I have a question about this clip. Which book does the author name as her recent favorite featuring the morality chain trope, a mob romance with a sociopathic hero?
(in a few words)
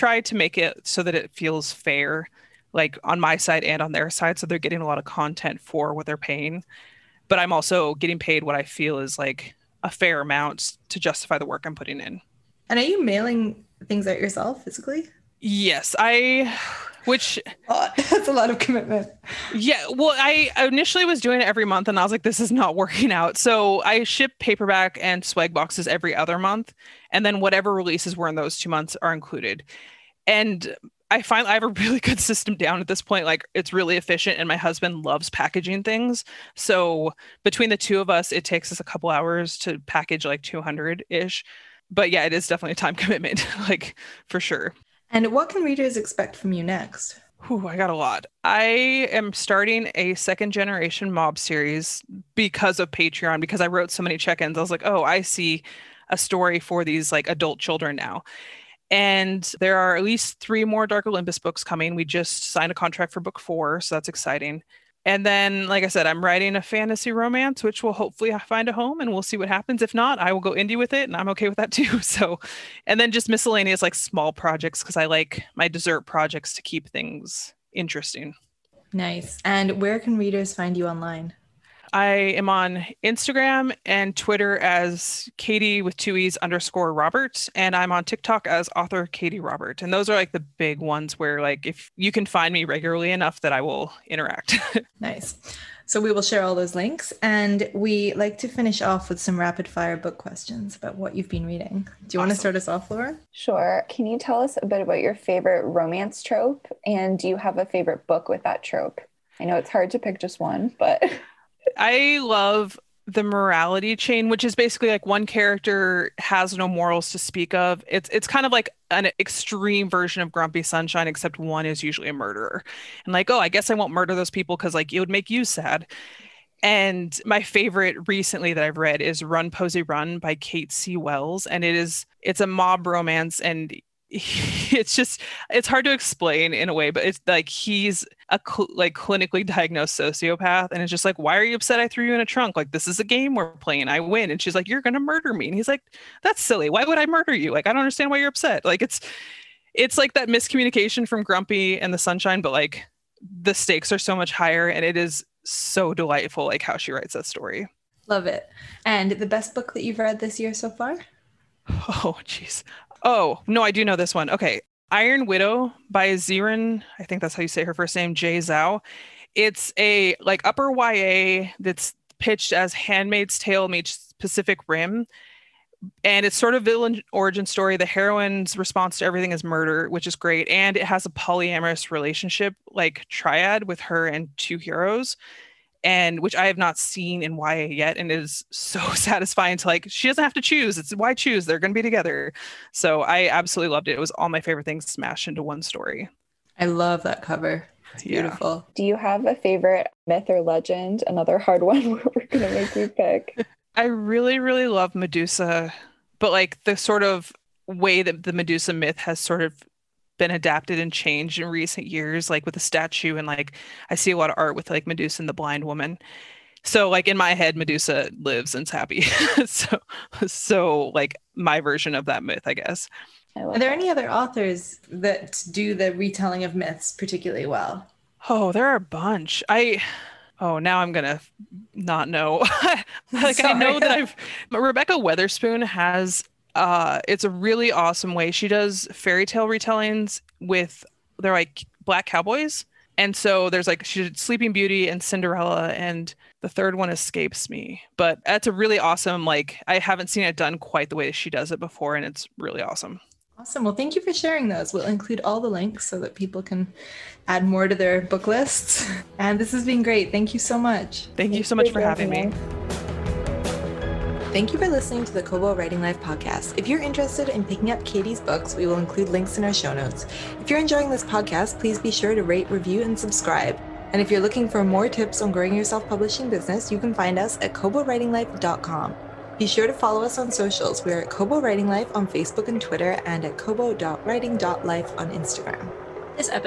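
Run Posey Run.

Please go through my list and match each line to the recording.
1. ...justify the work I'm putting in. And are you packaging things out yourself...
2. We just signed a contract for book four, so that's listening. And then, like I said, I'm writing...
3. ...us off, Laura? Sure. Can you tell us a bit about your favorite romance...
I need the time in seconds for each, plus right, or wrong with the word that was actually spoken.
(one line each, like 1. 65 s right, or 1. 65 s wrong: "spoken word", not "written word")
1. 10 s wrong: "mailing", not "packaging"
2. 61 s wrong: "exciting", not "listening"
3. 102 s right.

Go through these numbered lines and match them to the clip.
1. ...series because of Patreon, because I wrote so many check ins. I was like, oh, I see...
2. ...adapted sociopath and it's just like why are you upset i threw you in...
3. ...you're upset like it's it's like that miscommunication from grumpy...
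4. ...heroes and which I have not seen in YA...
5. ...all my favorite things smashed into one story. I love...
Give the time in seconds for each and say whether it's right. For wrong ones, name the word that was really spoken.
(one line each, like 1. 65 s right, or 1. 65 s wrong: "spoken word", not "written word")
1. 51 s right
2. 139 s wrong: "diagnosed", not "adapted"
3. 148 s right
4. 184 s right
5. 194 s right.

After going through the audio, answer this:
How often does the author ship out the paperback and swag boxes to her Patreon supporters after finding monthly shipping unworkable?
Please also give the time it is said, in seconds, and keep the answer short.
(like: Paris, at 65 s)
Every other month, at 25 s.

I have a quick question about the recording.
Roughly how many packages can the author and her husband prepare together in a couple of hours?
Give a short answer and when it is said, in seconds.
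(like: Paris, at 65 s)
200, at 40 s.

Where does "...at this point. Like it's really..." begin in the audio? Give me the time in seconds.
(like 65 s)
32 s.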